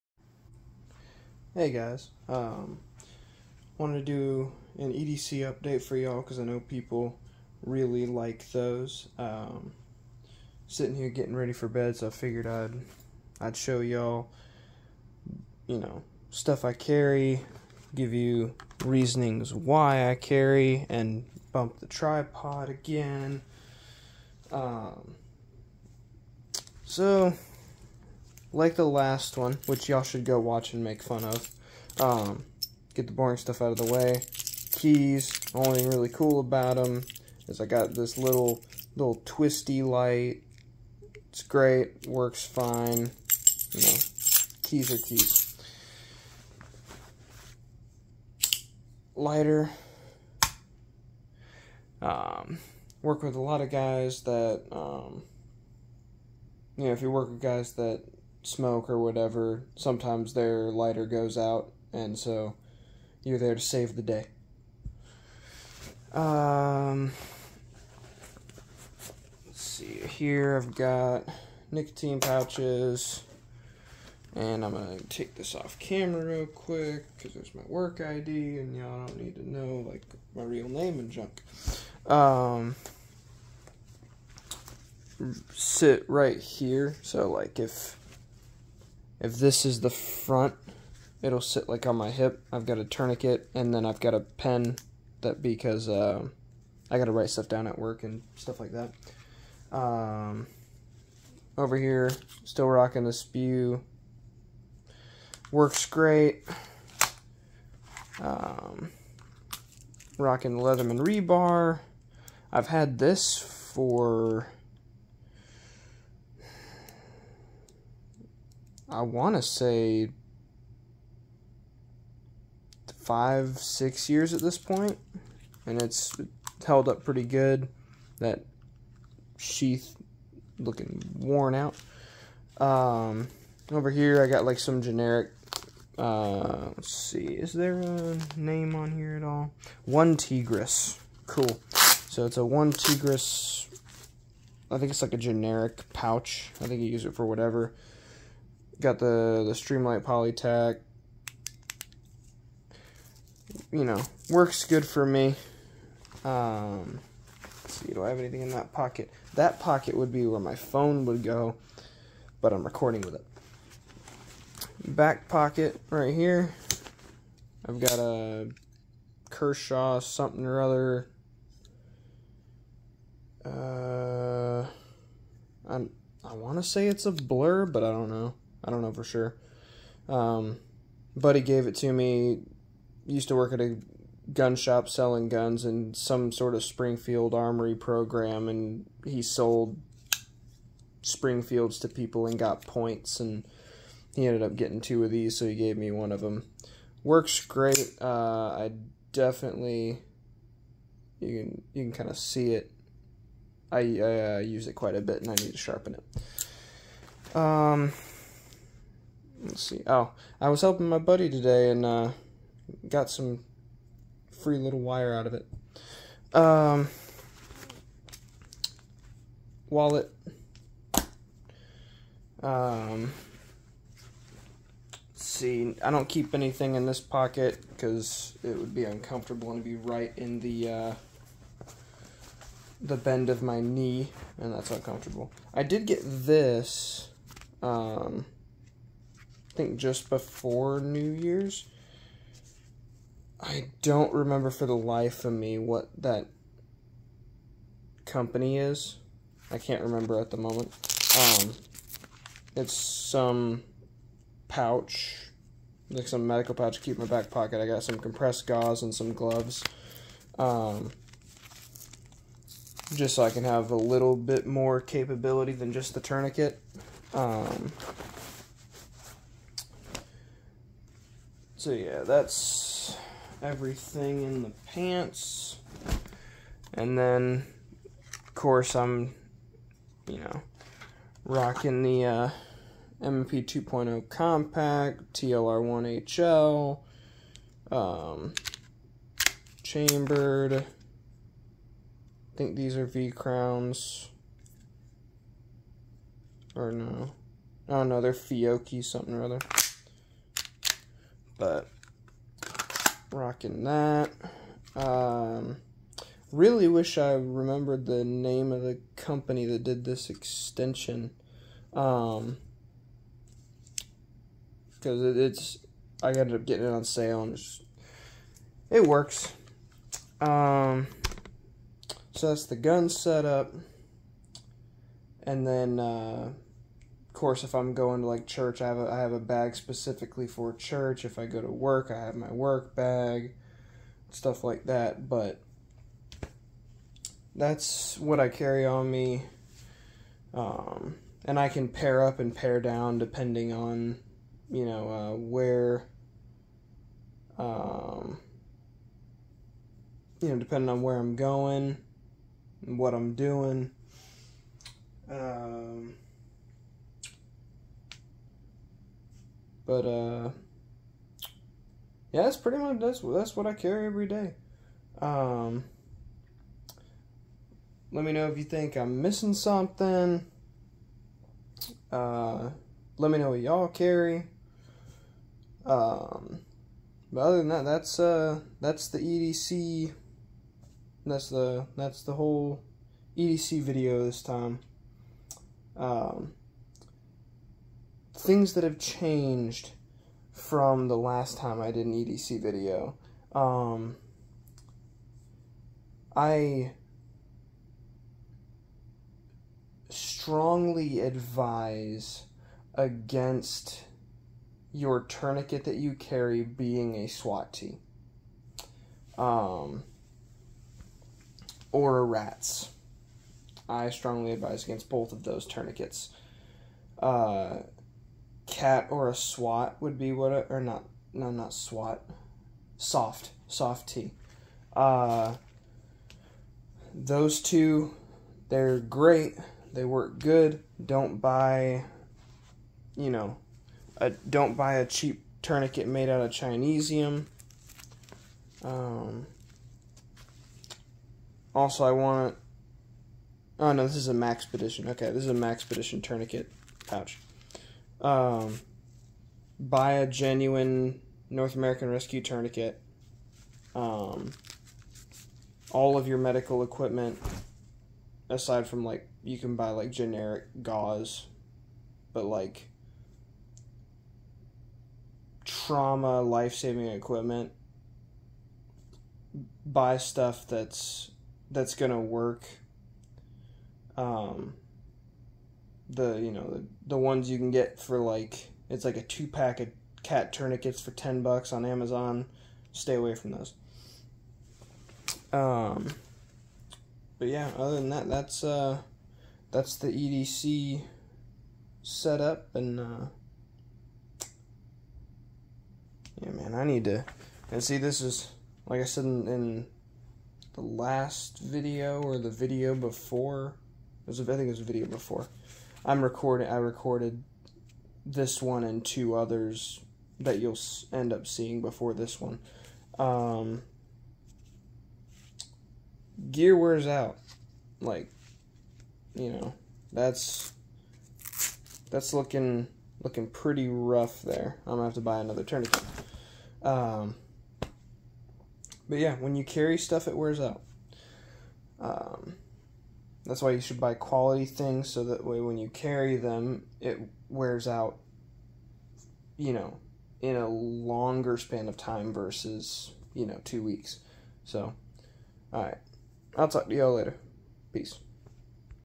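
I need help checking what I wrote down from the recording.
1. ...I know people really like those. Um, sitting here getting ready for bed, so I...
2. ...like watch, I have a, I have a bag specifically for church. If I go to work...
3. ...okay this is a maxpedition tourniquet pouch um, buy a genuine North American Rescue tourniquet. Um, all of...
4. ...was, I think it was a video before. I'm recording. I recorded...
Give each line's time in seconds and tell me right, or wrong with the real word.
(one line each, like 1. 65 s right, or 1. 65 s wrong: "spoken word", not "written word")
1. 6 s right
2. 328 s wrong: "church", not "watch"
3. 444 s right
4. 504 s right.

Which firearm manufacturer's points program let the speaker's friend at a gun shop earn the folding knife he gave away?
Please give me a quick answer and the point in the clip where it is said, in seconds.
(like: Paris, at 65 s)
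Springfield Armory, at 186 s.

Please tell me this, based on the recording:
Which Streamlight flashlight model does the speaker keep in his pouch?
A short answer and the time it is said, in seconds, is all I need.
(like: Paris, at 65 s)
PolyTac, at 150 s.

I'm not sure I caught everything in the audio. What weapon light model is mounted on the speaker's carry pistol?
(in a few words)
TLR1HL.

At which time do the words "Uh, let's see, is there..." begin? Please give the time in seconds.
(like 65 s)
135 s.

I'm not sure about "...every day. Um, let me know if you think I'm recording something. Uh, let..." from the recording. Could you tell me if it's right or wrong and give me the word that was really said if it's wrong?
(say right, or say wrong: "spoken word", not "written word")
wrong: "missing", not "recording".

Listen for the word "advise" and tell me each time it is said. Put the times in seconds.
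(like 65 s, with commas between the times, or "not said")
400 s, 414 s.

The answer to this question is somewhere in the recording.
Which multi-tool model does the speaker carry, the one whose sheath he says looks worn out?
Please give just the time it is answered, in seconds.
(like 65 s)
110 s.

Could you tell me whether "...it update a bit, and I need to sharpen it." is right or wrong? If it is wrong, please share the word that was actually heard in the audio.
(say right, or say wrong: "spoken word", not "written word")
wrong: "quite", not "update".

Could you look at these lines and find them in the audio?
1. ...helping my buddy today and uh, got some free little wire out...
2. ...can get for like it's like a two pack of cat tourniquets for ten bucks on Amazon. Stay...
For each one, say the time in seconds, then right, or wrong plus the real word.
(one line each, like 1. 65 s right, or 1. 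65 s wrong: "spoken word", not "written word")
1. 210 s right
2. 477 s right.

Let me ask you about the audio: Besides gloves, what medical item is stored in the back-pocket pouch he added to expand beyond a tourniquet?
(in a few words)
compressed gauze.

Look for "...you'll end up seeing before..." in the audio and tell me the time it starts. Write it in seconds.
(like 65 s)
510 s.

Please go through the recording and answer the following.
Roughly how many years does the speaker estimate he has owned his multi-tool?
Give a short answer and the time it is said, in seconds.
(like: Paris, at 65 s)
5 or 6, at 122 s.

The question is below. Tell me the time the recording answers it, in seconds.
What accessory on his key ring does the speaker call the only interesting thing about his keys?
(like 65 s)
39 s.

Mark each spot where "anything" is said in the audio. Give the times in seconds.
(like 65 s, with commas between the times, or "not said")
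158 s, 226 s.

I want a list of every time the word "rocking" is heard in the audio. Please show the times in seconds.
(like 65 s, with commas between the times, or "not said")
102 s, 110 s, 281 s, 303 s.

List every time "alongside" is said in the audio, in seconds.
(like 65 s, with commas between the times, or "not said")
not said.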